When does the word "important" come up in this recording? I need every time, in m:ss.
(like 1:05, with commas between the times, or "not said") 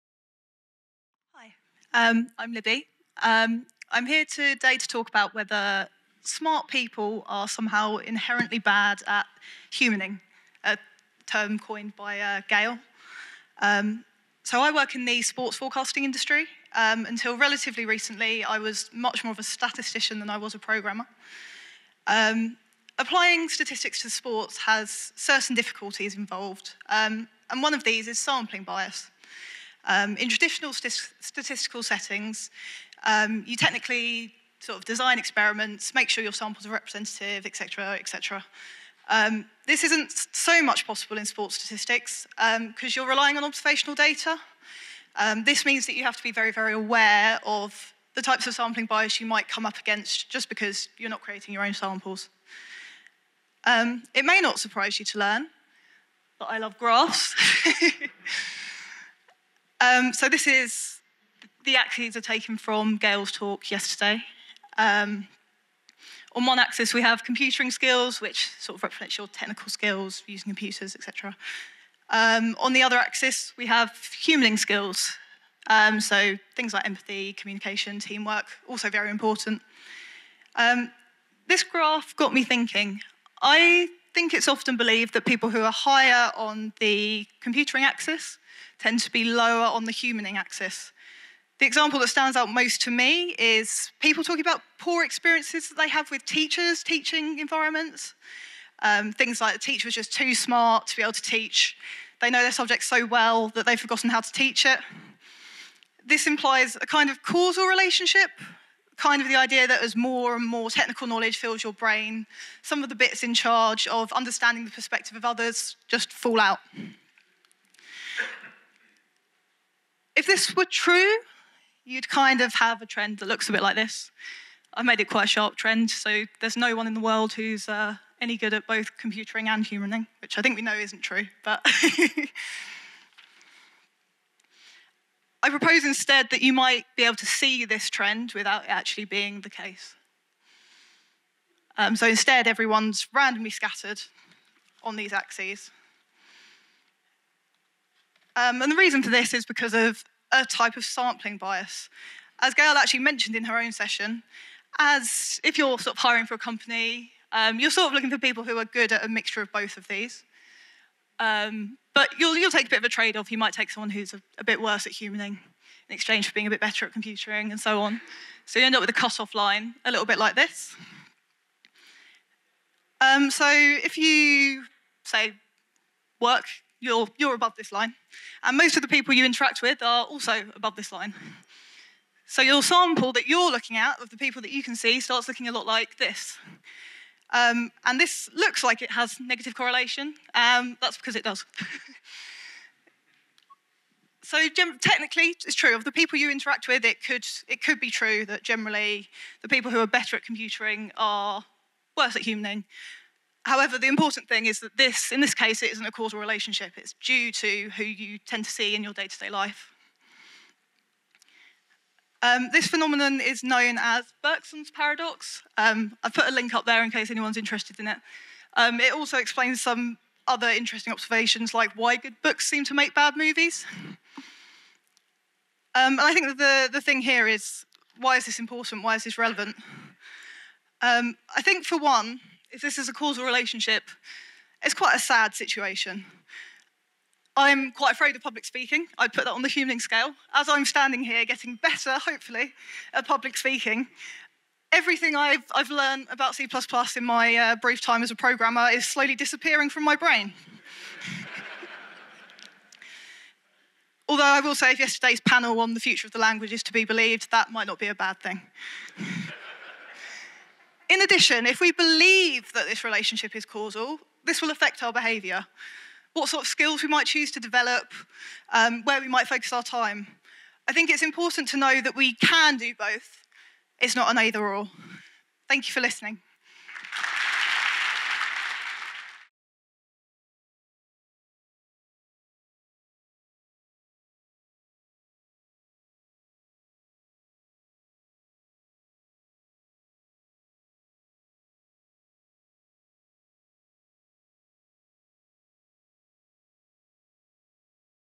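1:19, 3:23, 3:48, 4:31.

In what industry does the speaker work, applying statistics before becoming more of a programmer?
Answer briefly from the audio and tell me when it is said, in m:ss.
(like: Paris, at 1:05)
sports forecasting, at 0:15.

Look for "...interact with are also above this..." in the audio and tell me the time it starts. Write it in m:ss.
2:59.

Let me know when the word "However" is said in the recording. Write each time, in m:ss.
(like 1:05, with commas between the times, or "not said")
3:23.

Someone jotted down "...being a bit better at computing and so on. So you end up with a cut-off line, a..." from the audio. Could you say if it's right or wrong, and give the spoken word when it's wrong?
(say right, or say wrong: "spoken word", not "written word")
right.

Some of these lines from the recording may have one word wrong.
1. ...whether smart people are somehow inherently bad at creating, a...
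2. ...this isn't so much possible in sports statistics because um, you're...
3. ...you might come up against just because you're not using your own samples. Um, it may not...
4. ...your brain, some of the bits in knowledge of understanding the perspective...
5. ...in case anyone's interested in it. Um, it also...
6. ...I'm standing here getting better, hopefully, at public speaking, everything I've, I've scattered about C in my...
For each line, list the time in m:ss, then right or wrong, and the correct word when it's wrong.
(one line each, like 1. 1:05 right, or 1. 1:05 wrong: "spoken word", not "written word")
1. 0:05 wrong: "humaning", not "creating"
2. 0:39 right
3. 0:49 wrong: "creating", not "using"
4. 1:51 wrong: "charge", not "knowledge"
5. 3:36 right
6. 4:00 wrong: "learned", not "scattered".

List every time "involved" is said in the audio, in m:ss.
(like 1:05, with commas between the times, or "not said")
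0:26.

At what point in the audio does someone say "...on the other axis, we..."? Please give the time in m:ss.
1:12.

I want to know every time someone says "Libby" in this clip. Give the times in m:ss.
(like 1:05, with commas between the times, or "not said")
0:02.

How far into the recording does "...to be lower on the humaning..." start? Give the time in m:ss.
1:28.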